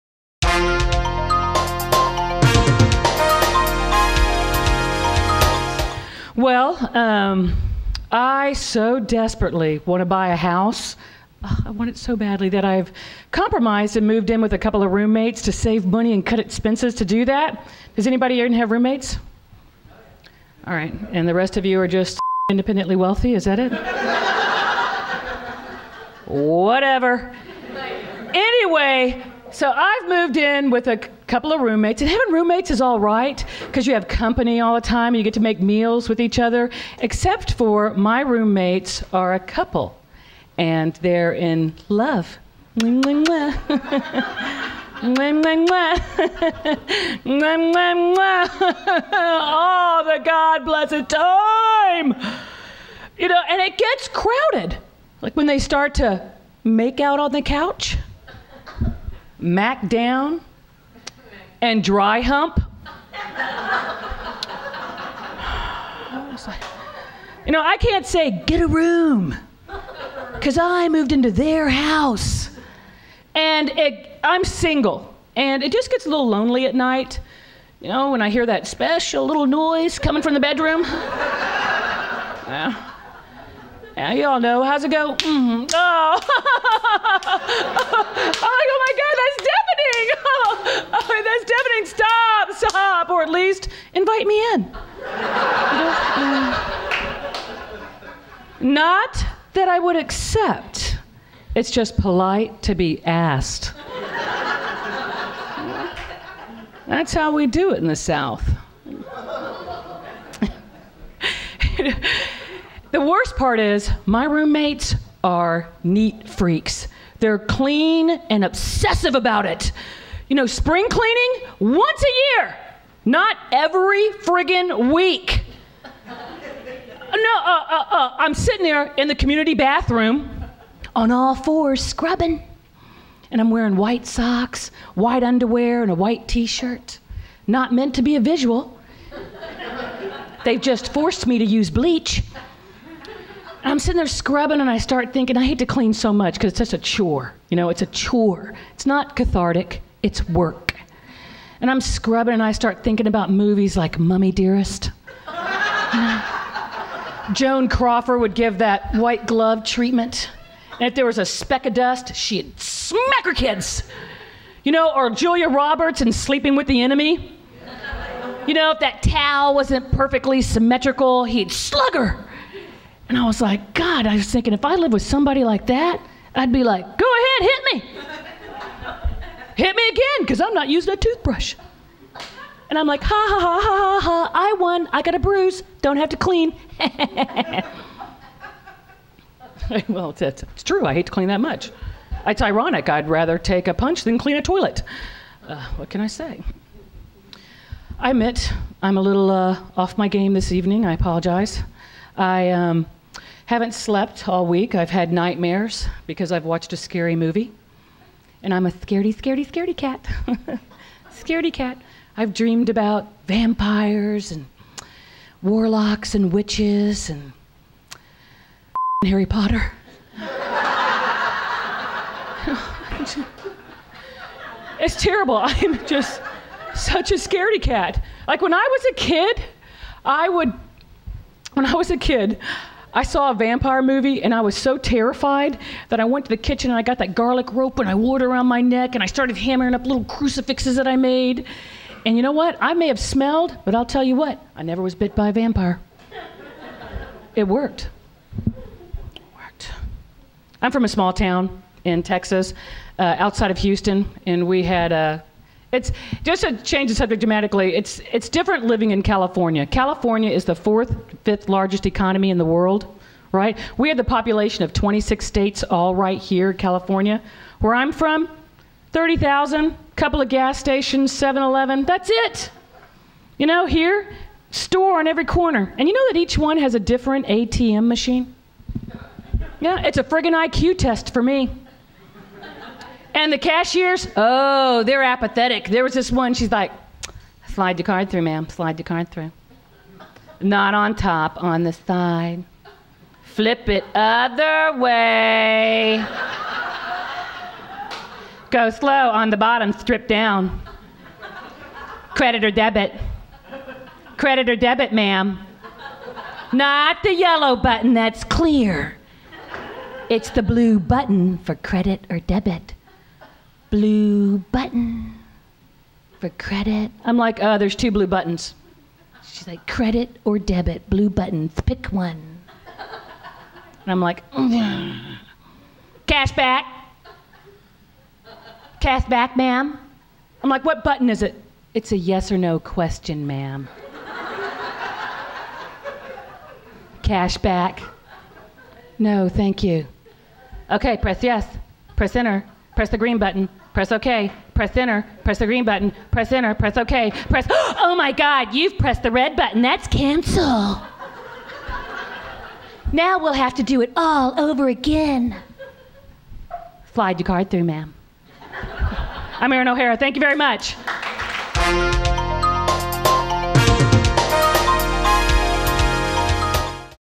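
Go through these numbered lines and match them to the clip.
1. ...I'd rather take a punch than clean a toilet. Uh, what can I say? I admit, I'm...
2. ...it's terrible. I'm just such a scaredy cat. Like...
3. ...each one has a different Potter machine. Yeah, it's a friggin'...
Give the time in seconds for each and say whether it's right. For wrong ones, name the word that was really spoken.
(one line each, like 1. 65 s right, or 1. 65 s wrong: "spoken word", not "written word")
1. 192 s right
2. 224 s right
3. 276 s wrong: "ATM", not "Potter".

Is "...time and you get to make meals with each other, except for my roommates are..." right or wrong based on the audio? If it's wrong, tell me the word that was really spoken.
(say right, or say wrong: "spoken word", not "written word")
right.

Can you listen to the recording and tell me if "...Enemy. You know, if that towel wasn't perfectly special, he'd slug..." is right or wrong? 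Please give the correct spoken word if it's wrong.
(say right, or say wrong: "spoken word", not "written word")
wrong: "symmetrical", not "special".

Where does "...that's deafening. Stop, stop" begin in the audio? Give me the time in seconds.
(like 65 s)
91 s.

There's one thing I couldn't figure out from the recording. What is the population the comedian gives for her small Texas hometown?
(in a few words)
30,000.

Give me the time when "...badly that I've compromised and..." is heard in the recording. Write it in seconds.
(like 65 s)
12 s.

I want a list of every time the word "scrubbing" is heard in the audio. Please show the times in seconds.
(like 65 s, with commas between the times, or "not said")
131 s, 144 s, 151 s.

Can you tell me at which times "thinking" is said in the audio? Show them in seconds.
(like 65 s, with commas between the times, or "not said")
145 s, 152 s, 174 s.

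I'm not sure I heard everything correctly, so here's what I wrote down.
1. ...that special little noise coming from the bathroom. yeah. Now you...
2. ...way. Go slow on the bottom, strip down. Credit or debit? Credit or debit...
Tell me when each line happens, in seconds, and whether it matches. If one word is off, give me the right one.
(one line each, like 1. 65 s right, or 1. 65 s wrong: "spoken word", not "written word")
1. 78 s wrong: "bedroom", not "bathroom"
2. 294 s right.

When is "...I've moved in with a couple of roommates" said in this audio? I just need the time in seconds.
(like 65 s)
29 s.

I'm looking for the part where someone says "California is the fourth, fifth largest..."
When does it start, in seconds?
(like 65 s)
259 s.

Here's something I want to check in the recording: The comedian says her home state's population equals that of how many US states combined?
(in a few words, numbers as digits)
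26.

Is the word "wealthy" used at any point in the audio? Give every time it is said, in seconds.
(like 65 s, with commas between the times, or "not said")
22 s.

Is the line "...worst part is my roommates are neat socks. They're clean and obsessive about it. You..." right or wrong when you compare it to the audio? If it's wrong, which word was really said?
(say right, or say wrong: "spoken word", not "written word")
wrong: "freaks", not "socks".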